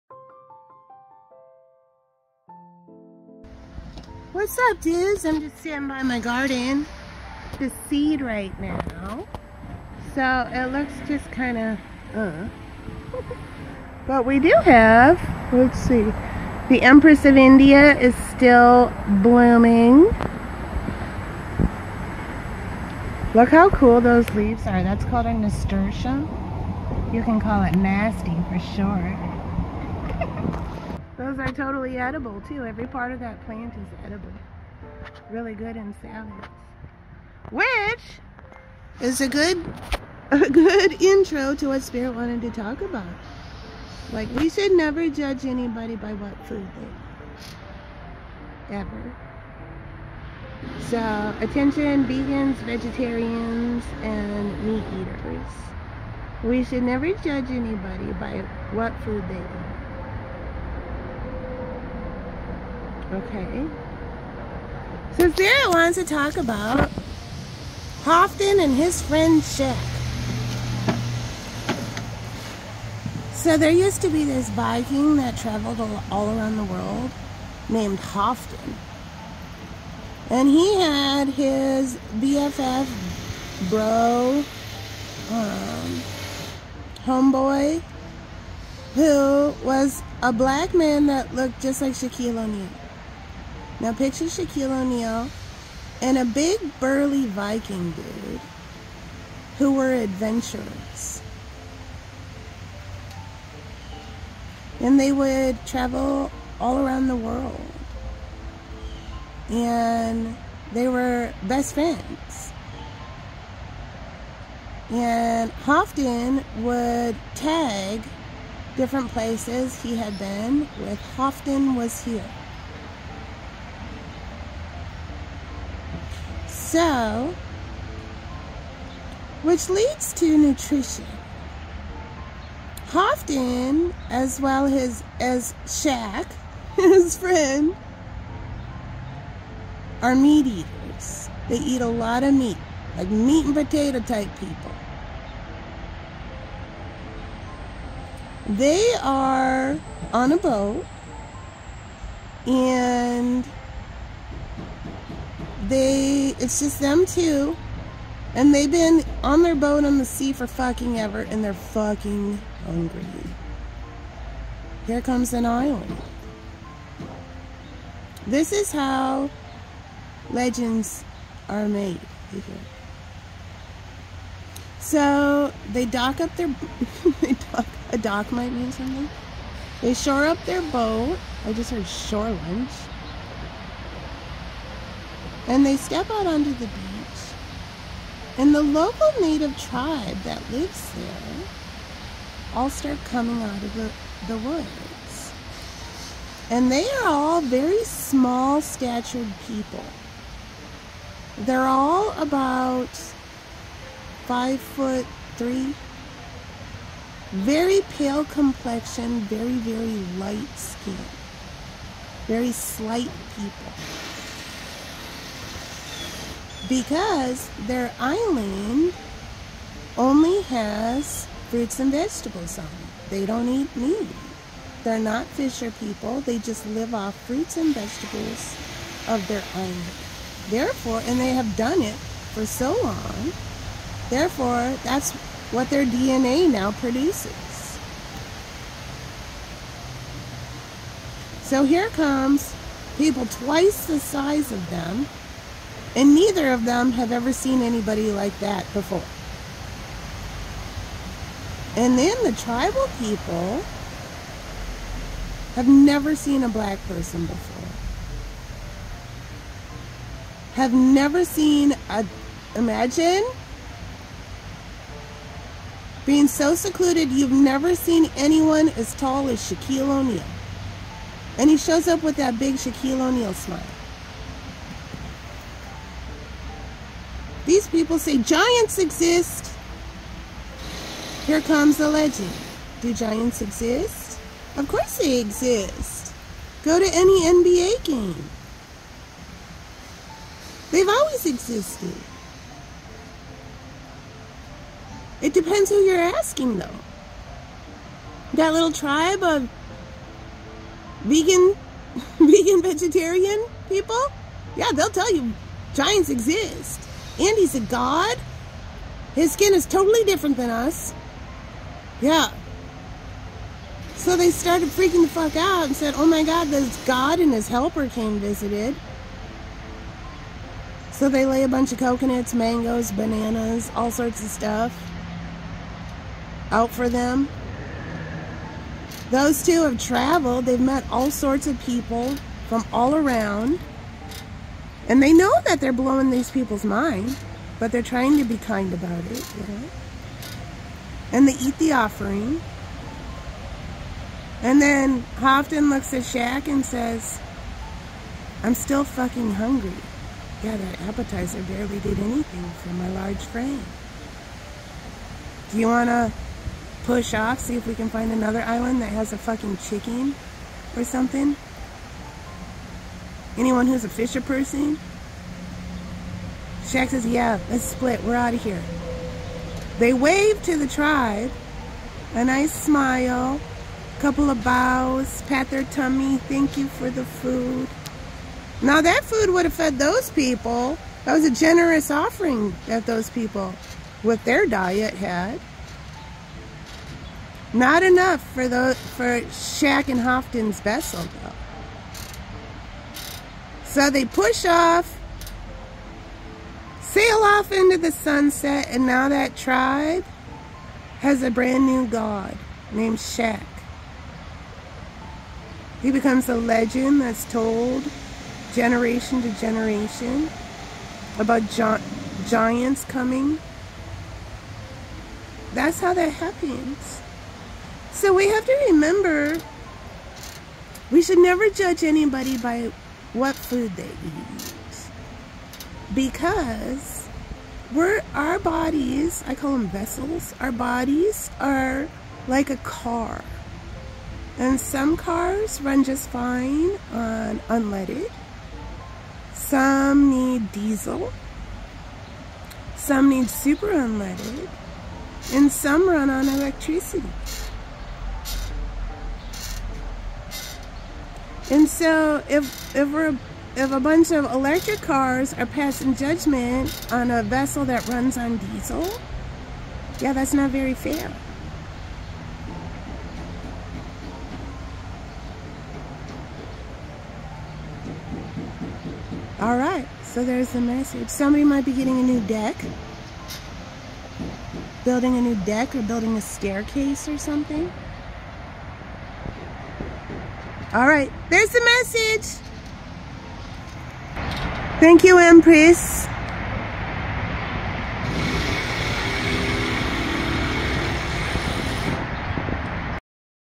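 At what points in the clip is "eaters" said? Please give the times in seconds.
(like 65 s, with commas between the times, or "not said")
54 s, 140 s.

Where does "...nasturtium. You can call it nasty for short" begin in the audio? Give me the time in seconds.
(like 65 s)
25 s.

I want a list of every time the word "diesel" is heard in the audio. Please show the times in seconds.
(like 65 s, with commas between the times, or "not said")
440 s, 458 s.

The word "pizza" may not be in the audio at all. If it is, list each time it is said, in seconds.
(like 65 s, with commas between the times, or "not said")
not said.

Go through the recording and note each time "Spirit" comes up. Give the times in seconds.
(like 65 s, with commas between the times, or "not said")
41 s, 65 s.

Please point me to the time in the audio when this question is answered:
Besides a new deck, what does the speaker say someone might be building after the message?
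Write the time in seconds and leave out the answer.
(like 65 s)
476 s.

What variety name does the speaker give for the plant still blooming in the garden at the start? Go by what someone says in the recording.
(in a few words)
Empress of India.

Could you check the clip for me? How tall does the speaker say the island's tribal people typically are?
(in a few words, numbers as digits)
5 foot 3.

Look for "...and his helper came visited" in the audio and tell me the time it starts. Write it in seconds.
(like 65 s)
317 s.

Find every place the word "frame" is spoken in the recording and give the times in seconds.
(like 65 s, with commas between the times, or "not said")
353 s.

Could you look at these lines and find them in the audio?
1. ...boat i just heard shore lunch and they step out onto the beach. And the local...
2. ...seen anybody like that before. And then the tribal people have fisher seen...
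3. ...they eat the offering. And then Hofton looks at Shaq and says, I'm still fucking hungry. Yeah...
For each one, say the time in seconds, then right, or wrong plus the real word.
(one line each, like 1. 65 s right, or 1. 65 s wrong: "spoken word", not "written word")
1. 180 s right
2. 247 s wrong: "never", not "fisher"
3. 341 s right.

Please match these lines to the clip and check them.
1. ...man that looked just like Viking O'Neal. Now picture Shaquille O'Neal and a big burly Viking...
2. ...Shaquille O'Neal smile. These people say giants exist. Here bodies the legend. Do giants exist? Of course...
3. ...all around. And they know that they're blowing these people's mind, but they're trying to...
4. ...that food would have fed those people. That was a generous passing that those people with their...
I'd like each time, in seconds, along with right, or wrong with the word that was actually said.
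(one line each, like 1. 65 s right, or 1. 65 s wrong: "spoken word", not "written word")
1. 90 s wrong: "Shaquille", not "Viking"
2. 272 s wrong: "comes", not "bodies"
3. 332 s right
4. 378 s wrong: "offering", not "passing".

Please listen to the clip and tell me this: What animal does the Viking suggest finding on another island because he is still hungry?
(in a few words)
chicken.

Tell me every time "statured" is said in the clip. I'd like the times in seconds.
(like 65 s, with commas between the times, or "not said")
198 s.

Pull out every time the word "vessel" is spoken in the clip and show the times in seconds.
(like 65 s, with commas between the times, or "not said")
390 s, 429 s, 457 s.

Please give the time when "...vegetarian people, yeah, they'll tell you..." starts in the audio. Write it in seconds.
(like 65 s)
302 s.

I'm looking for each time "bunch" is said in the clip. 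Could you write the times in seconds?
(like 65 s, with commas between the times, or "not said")
321 s, 453 s.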